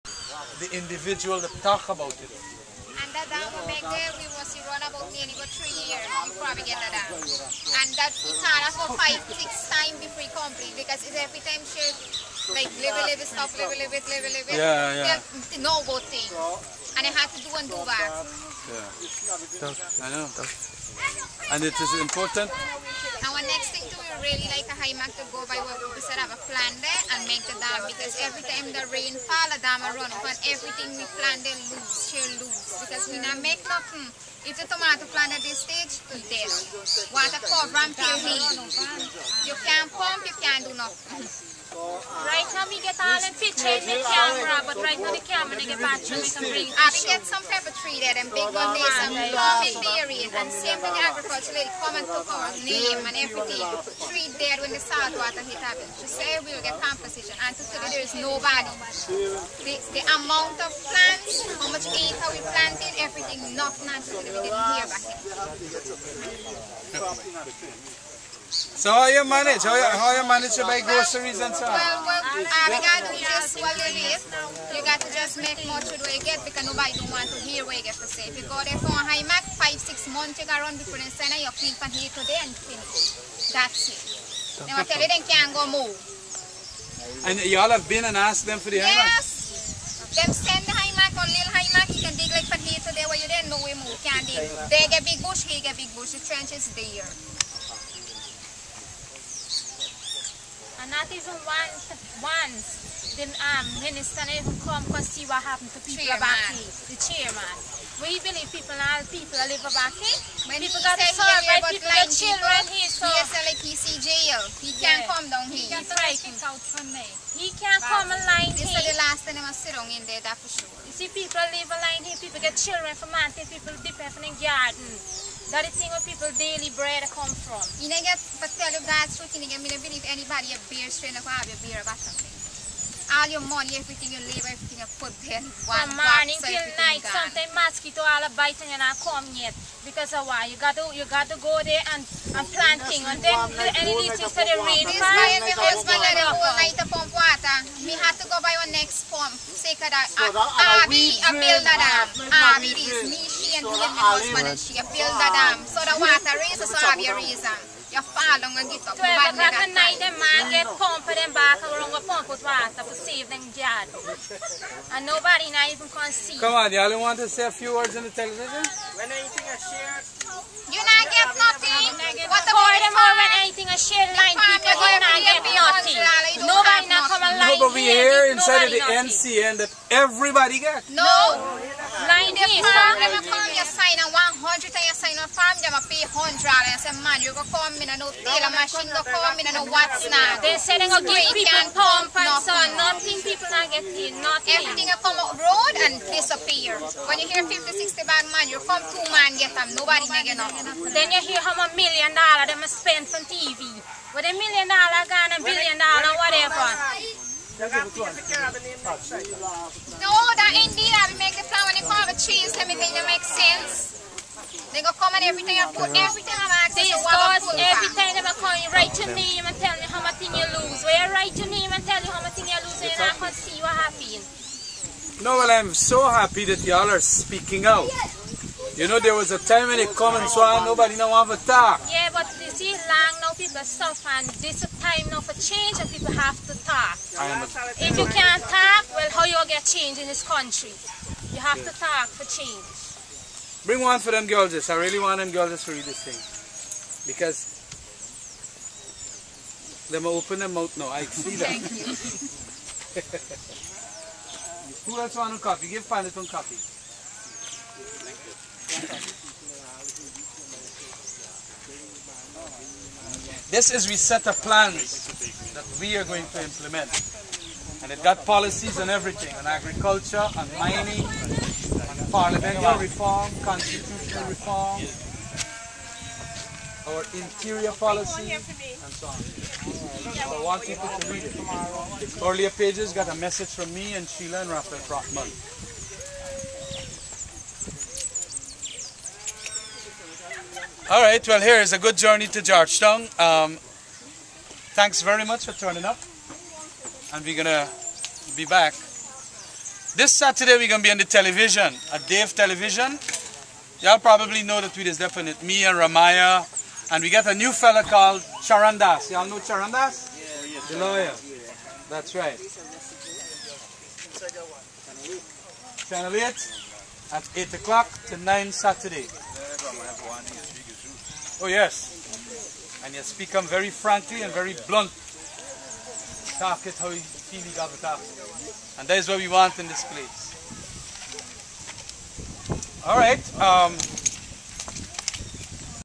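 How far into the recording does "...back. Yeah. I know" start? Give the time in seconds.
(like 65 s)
17 s.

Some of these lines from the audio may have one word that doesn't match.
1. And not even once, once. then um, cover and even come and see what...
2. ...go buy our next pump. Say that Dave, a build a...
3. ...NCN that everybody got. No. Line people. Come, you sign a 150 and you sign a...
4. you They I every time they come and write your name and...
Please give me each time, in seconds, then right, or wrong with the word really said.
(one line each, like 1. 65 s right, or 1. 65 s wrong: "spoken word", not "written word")
1. 100 s wrong: "minister", not "cover"
2. 148 s wrong: "Abby", not "Dave"
3. 179 s wrong: "100", not "150"
4. 216 s right.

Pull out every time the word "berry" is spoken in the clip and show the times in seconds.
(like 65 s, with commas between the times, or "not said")
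49 s.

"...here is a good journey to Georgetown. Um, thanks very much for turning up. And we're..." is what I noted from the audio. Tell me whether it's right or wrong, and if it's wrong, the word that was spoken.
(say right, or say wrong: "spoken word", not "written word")
right.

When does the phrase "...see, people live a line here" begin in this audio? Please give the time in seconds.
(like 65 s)
120 s.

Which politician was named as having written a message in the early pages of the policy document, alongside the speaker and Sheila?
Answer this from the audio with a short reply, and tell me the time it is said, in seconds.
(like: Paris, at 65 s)
Raphael Trotman, at 284 s.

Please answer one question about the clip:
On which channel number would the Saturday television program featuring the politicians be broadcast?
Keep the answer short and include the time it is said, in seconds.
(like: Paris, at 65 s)
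8, at 315 s.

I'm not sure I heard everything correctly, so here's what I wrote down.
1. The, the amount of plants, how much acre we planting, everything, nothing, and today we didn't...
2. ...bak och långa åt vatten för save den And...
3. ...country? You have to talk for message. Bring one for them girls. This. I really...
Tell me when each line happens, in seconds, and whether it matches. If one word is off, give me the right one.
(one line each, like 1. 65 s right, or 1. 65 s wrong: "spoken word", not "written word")
1. 59 s right
2. 161 s right
3. 240 s wrong: "change", not "message".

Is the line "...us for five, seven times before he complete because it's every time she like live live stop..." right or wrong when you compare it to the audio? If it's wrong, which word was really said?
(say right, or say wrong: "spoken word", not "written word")
wrong: "six", not "seven".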